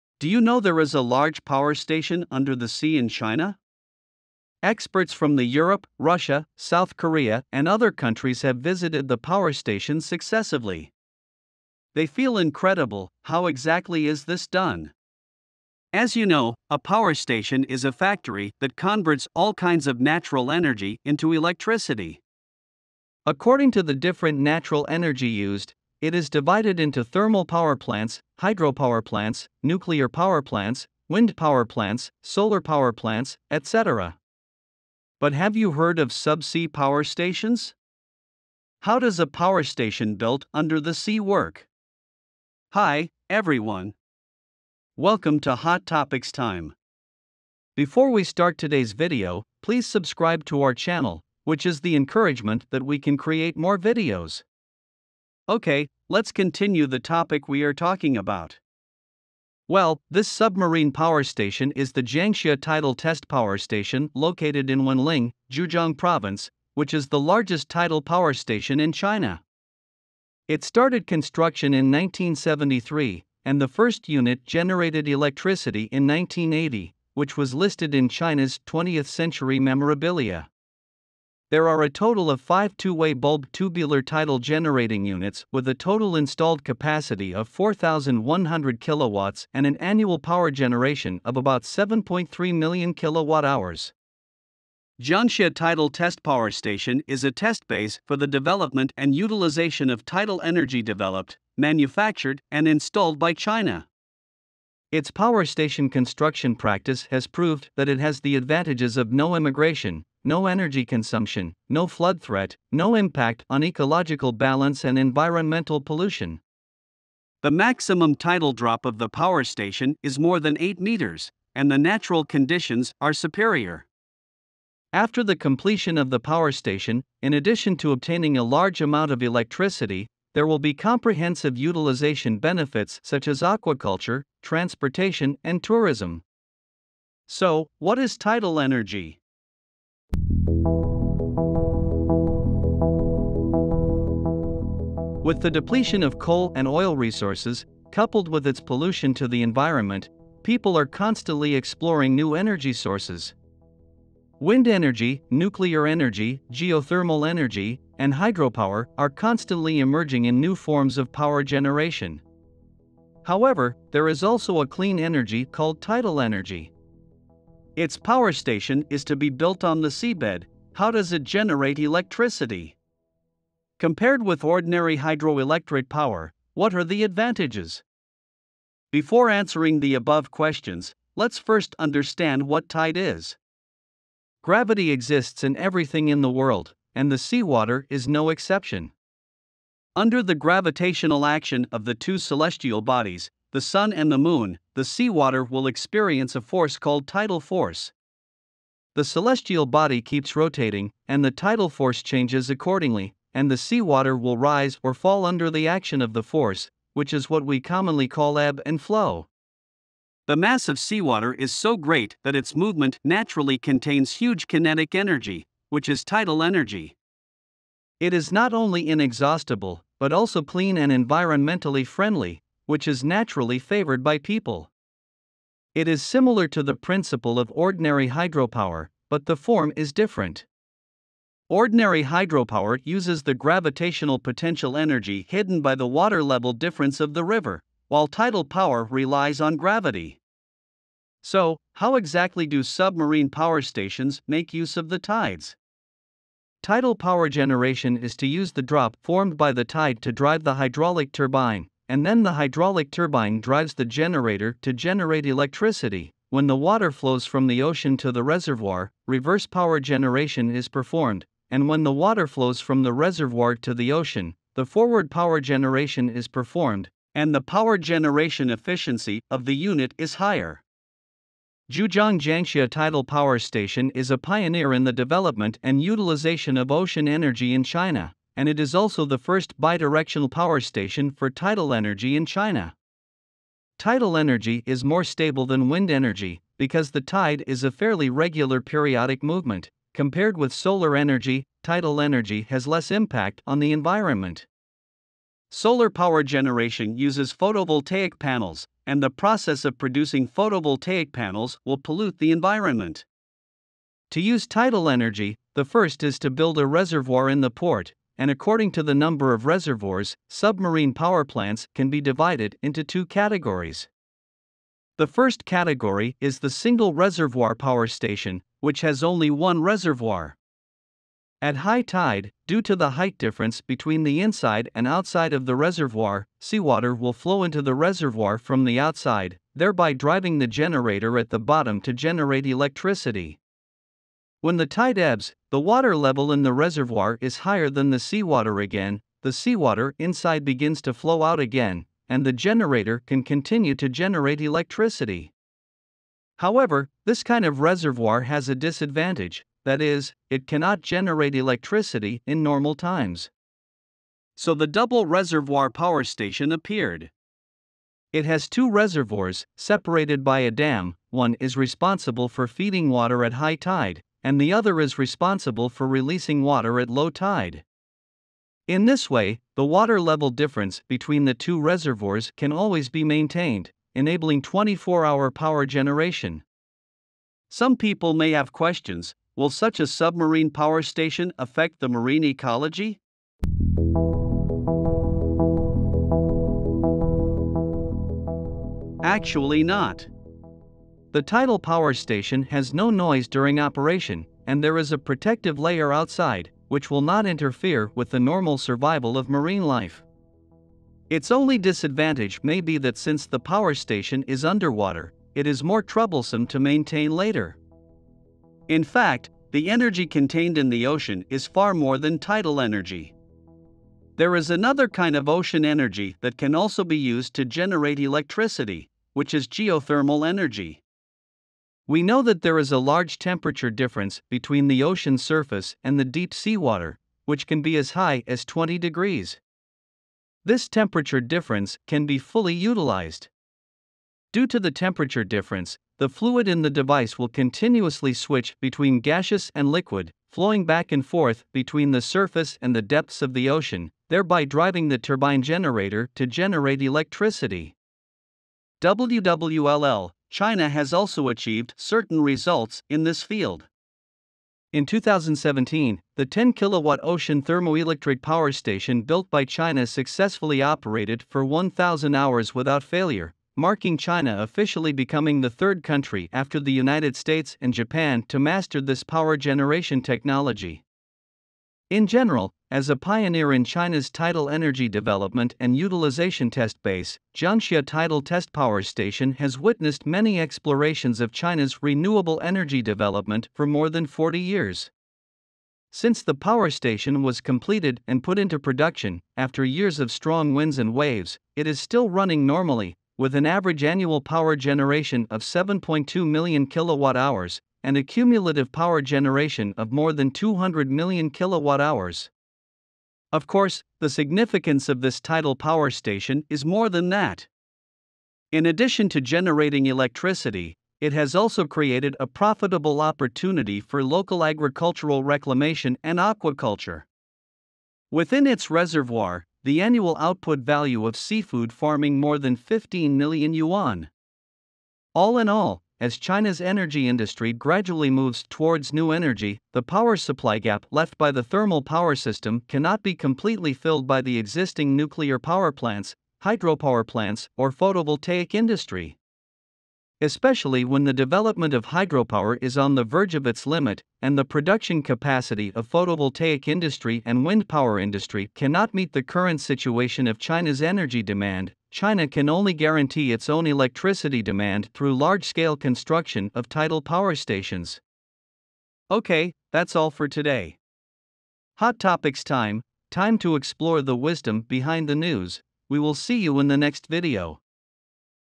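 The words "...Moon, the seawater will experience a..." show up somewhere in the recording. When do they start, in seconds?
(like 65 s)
194 s.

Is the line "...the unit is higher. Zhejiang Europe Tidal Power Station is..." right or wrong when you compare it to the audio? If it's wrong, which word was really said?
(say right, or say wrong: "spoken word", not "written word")
wrong: "Jiangxia", not "Europe".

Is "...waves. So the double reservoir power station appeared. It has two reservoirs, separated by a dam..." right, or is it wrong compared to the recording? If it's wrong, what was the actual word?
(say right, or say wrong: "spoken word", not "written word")
wrong: "times", not "waves".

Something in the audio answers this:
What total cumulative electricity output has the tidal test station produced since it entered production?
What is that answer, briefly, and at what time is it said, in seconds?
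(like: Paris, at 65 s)
more than 200 million kilowatt hours, at 499 s.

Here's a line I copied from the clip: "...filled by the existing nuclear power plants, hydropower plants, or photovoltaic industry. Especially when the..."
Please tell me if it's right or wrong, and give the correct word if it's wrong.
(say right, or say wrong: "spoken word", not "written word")
right.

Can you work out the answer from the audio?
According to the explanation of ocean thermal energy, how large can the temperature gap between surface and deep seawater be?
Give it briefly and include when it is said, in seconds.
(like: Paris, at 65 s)
20 degrees, at 428 s.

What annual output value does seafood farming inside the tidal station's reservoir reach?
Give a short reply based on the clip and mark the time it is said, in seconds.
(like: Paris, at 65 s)
more than 15 million yuan, at 522 s.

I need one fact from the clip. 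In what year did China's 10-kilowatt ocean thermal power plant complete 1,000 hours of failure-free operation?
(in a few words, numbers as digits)
2017.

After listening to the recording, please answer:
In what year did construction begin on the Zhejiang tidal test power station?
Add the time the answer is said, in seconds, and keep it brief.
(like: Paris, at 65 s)
1973, at 71 s.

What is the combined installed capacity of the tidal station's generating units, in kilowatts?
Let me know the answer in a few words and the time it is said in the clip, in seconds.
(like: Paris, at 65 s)
4,100 kilowatts, at 87 s.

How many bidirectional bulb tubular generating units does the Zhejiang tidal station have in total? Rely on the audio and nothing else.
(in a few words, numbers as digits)
5.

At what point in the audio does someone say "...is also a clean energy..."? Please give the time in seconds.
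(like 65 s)
164 s.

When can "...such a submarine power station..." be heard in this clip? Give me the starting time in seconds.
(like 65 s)
379 s.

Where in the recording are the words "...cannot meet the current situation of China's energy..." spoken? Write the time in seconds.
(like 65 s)
548 s.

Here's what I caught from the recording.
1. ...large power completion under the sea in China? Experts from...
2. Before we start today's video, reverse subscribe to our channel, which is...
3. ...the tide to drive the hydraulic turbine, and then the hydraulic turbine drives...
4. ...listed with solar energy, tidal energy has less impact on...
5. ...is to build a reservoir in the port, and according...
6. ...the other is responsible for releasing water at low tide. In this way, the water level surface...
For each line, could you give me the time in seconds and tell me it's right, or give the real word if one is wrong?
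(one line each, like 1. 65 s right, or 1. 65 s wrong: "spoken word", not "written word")
1. 1 s wrong: "station", not "completion"
2. 47 s wrong: "please", not "reverse"
3. 249 s right
4. 289 s wrong: "compared", not "listed"
5. 306 s right
6. 364 s wrong: "difference", not "surface".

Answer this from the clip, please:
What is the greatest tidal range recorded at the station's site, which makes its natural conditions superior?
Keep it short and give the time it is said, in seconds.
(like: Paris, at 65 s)
more than 8 meters, at 120 s.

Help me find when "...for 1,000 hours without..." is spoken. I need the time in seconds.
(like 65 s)
461 s.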